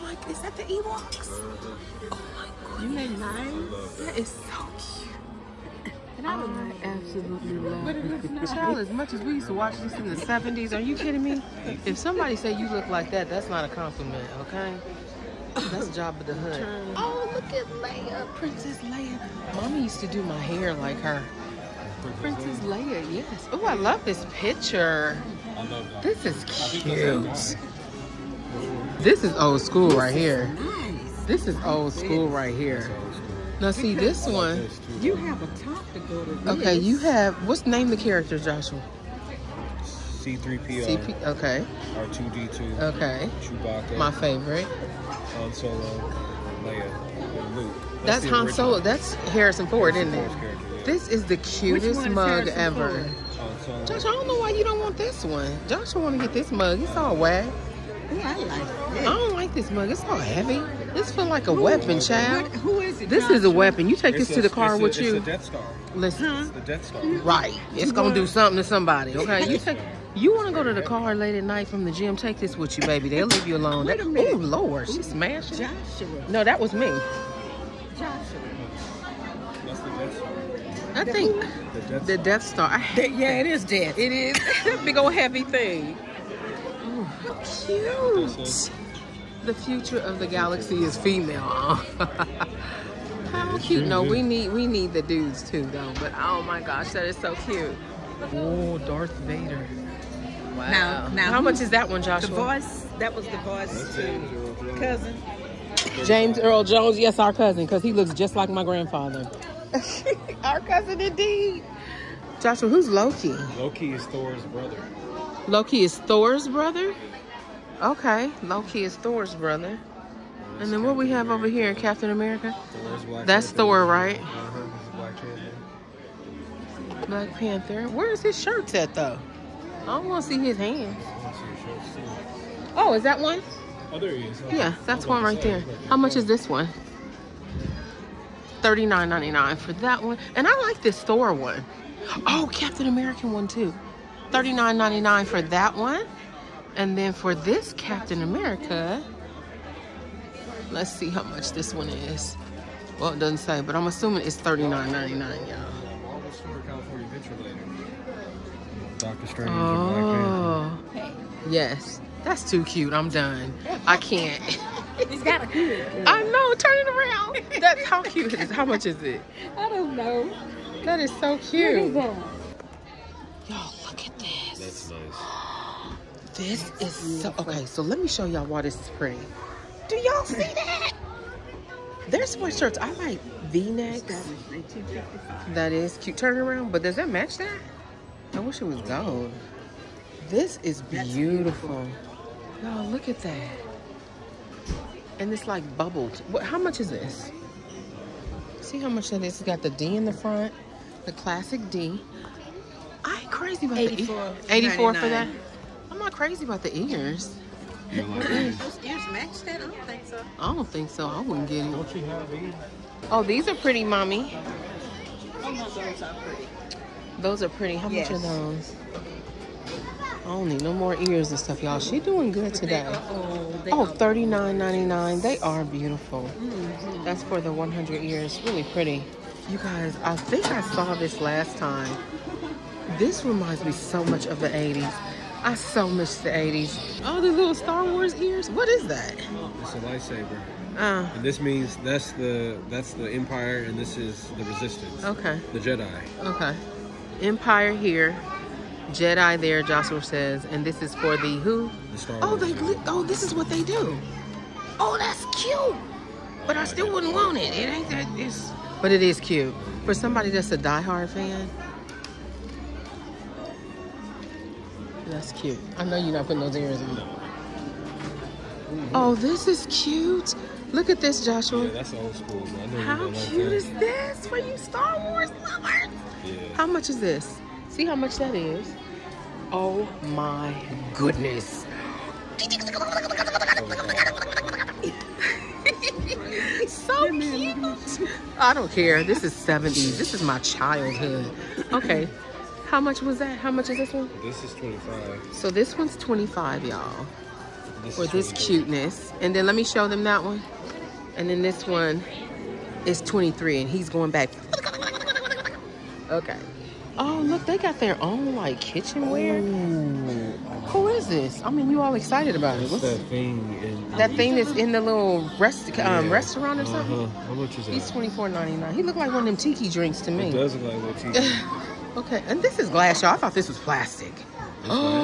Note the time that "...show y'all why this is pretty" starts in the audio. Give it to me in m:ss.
2:58.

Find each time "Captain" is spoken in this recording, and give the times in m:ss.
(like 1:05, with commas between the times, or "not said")
2:01, 2:22, 2:27.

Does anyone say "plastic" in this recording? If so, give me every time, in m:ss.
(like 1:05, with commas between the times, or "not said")
5:23.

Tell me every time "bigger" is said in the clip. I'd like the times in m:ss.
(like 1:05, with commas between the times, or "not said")
not said.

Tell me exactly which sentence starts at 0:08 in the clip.
as much as we used to watch this in the 70s, are you kidding me?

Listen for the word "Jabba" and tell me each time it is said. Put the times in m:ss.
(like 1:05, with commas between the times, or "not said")
0:15.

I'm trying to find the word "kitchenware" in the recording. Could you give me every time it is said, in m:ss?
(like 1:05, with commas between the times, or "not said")
5:08.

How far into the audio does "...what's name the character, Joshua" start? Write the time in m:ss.
0:37.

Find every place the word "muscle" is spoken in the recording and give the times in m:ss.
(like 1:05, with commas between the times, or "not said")
not said.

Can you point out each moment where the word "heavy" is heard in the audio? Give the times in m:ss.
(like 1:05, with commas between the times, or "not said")
1:00, 1:25.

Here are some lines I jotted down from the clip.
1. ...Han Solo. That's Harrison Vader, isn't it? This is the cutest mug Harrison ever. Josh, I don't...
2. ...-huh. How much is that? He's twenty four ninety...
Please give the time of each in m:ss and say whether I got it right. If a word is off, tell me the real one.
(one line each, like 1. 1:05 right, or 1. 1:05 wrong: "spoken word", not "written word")
1. 0:48 wrong: "Ford", not "Vader"
2. 5:17 right.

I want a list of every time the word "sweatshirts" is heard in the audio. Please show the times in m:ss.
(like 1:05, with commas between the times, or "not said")
3:02.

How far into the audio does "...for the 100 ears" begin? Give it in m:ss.
3:47.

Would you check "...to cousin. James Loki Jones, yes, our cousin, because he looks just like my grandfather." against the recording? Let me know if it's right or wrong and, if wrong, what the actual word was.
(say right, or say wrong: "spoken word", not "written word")
wrong: "Earl", not "Loki".